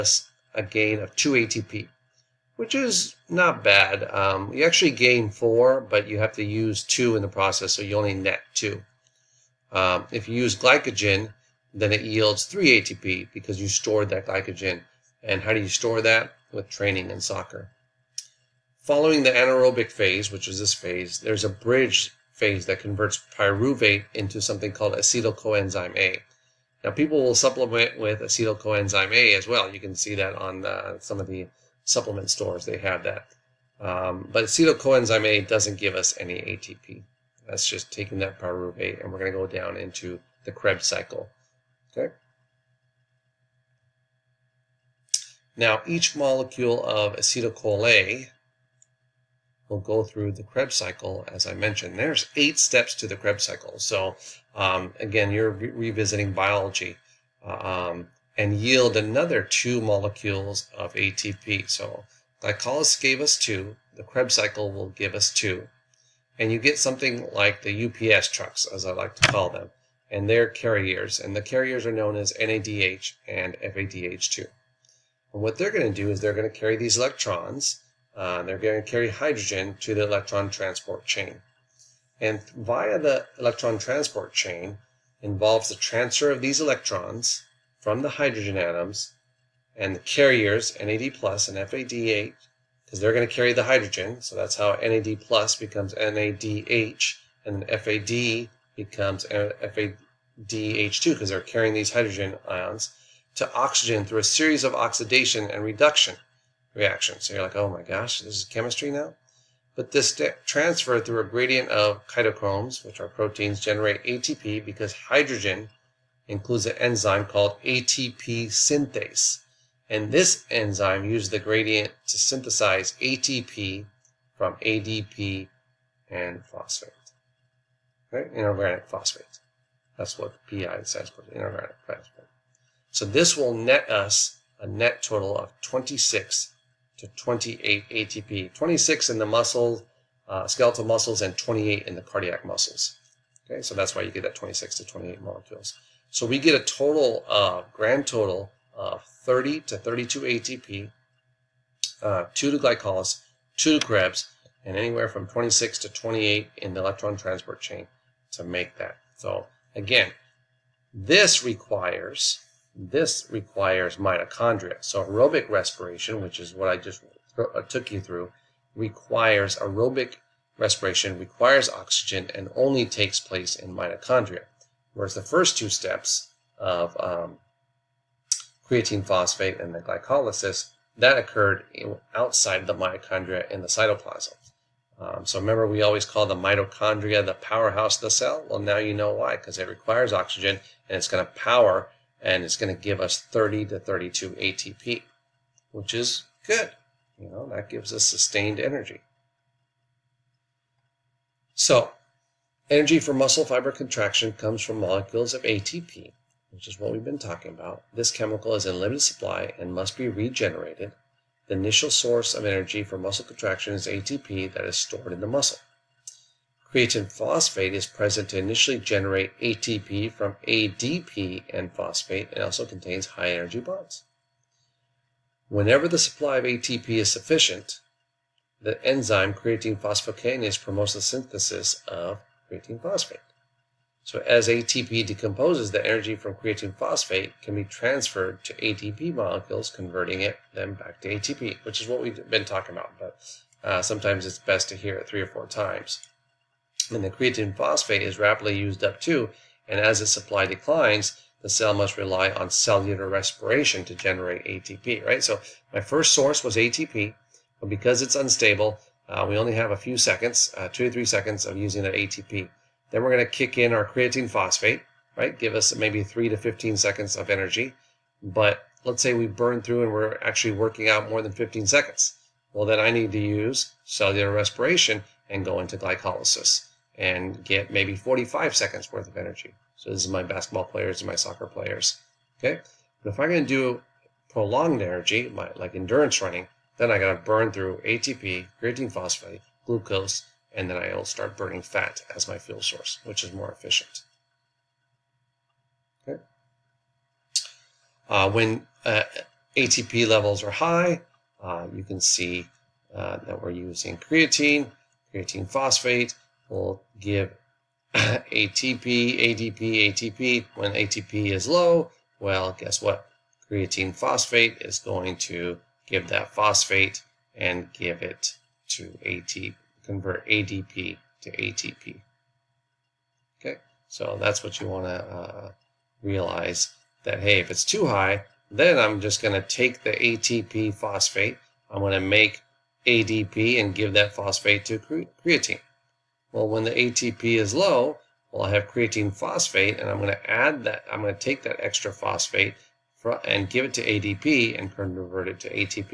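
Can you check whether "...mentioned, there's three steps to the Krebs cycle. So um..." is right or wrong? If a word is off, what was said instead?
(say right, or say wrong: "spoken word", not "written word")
wrong: "eight", not "three".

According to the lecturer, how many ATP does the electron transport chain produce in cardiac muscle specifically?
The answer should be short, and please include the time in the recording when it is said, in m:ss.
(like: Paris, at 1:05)
28, at 2:21.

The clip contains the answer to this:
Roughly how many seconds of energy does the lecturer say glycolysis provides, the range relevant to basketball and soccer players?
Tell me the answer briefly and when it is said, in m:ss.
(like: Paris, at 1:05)
45 seconds, at 4:37.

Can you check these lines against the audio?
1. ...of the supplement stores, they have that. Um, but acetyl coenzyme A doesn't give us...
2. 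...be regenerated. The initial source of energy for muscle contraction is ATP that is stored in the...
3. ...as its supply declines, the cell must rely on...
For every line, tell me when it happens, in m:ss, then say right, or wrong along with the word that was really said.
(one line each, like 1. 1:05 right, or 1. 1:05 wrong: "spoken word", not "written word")
1. 0:31 right
2. 3:29 right
3. 4:09 right.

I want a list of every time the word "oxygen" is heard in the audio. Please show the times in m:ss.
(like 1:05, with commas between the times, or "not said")
1:43, 2:51, 3:10.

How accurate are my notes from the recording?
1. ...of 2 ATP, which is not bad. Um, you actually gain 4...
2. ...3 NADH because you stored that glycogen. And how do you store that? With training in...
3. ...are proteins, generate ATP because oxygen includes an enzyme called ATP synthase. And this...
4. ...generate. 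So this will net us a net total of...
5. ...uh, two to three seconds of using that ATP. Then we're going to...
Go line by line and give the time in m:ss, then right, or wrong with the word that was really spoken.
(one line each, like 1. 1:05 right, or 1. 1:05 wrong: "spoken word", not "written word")
1. 0:00 right
2. 0:12 wrong: "ATP", not "NADH"
3. 1:52 wrong: "hydrogen", not "oxygen"
4. 2:11 wrong: "phosphate", not "generate"
5. 4:20 right.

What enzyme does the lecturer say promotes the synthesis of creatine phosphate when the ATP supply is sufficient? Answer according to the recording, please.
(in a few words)
creatine phosphokinase.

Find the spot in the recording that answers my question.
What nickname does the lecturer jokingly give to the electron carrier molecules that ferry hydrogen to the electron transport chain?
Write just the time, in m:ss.
1:07.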